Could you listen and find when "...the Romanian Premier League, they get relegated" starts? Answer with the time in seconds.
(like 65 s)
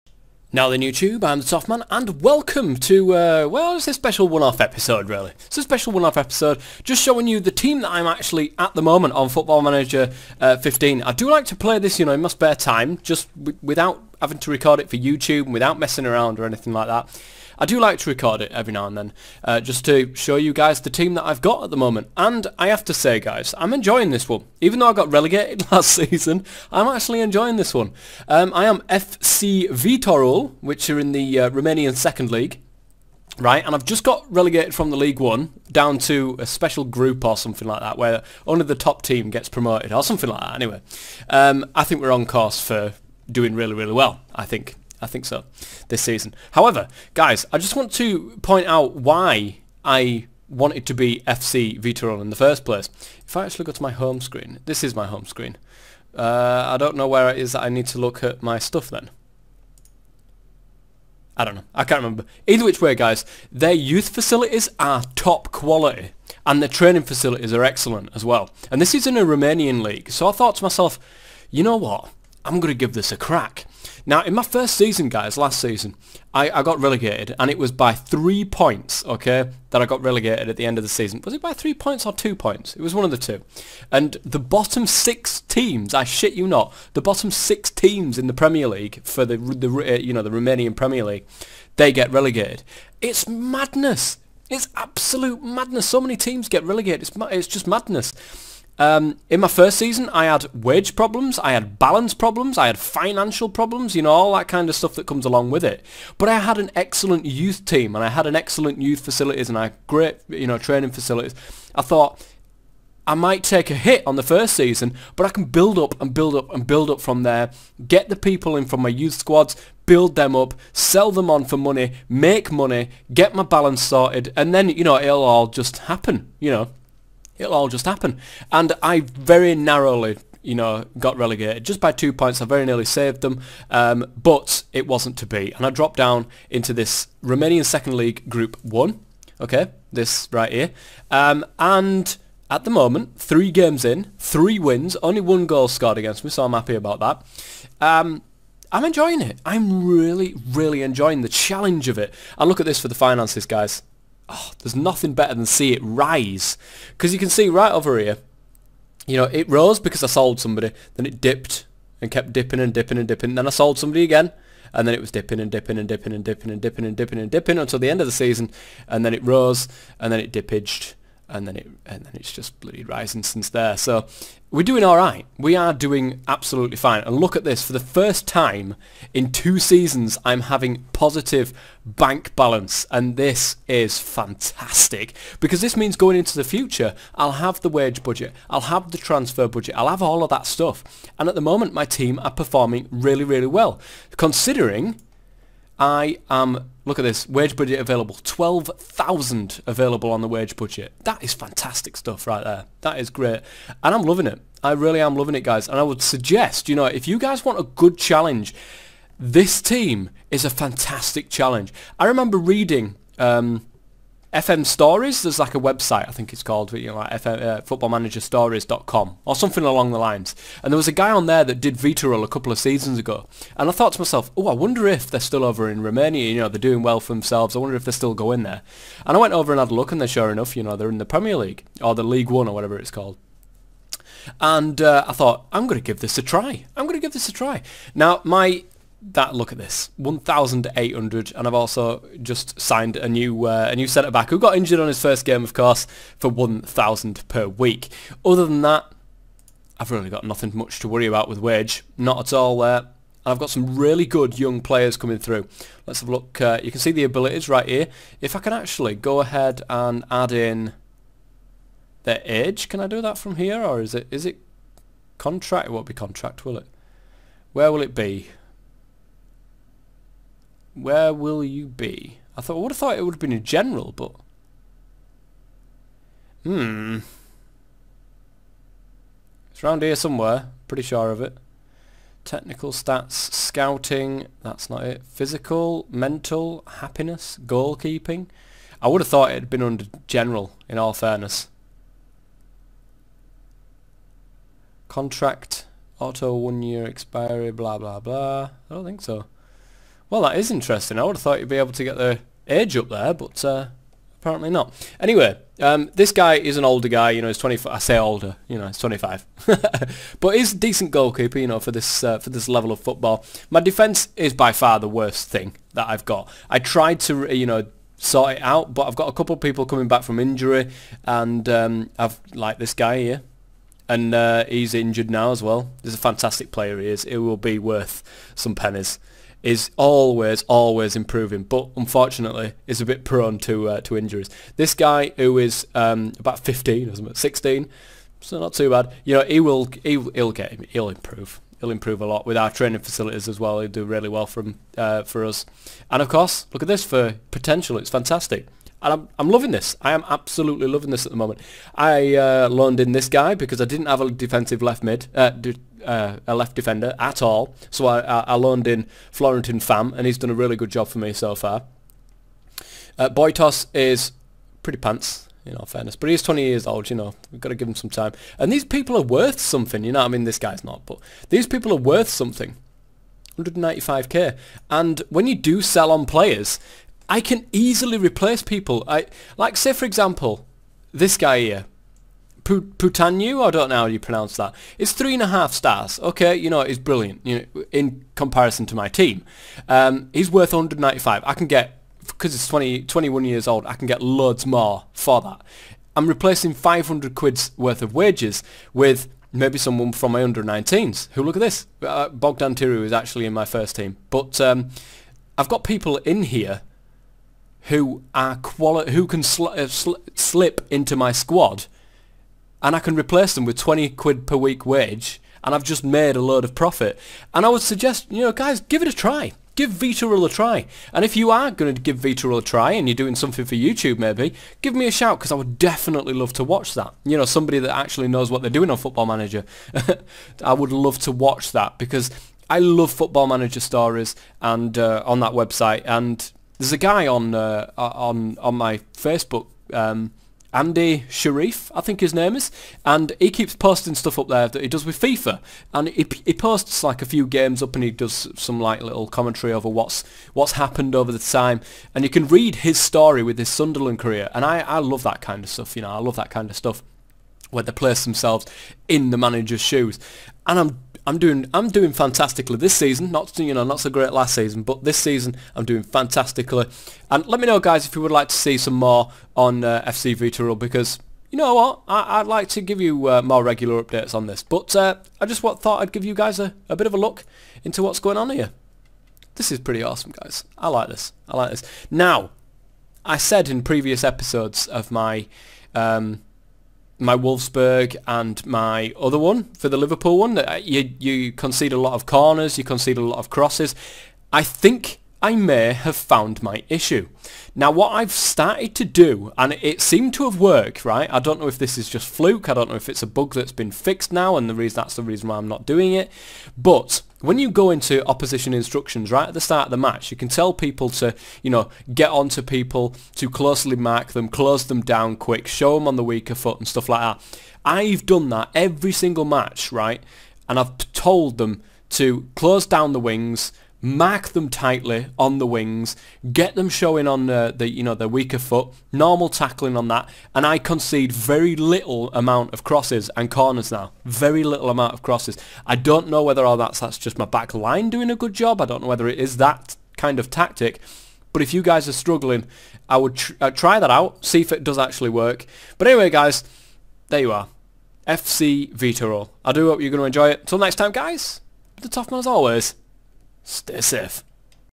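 90 s.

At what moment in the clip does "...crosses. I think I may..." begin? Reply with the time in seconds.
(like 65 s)
493 s.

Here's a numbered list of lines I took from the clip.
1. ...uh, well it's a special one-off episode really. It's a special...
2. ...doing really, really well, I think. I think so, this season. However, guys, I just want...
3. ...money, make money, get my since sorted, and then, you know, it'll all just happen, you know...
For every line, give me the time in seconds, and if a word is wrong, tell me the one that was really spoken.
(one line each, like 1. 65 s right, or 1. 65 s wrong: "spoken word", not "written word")
1. 3 s right
2. 43 s right
3. 121 s wrong: "balance", not "since".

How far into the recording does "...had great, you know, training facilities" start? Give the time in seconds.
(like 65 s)
109 s.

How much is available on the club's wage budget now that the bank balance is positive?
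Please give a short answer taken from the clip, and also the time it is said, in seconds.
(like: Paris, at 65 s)
12,000, at 198 s.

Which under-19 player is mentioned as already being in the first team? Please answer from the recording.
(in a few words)
Bogdan Tiru.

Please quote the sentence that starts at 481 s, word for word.
Now, I said in previous episodes of my um, my Wolfsburg and my other one for the Liverpool one.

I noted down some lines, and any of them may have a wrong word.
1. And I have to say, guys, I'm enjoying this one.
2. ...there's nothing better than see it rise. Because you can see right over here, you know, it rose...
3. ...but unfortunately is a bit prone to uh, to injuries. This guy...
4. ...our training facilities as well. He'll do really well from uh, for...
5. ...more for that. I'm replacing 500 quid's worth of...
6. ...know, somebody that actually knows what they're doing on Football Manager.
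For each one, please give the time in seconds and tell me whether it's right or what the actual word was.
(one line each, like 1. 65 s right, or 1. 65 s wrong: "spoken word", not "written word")
1. 22 s right
2. 154 s right
3. 331 s right
4. 342 s right
5. 394 s right
6. 427 s right.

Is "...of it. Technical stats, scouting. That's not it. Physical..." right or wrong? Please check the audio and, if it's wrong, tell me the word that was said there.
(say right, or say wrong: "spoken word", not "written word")
right.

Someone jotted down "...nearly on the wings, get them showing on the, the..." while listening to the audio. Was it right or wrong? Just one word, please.
wrong.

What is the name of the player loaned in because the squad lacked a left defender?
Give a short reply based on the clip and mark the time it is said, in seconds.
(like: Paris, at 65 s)
Florentin Fam, at 359 s.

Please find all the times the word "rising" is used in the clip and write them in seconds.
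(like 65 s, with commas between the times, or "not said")
172 s.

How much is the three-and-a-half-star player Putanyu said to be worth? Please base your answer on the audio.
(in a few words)
195k.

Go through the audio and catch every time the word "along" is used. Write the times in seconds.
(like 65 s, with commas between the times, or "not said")
105 s, 219 s.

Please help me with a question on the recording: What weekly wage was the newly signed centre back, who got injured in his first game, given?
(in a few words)
1000.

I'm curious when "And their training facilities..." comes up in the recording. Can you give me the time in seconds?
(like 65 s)
66 s.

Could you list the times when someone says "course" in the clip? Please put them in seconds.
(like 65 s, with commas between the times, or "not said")
42 s, 245 s, 346 s.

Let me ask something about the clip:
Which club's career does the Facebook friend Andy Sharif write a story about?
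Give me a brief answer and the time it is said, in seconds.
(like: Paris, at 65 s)
Sunderland, at 453 s.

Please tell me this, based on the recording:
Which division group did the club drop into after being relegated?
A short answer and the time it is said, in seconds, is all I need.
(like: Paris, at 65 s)
Romanian Second League Group 1, at 137 s.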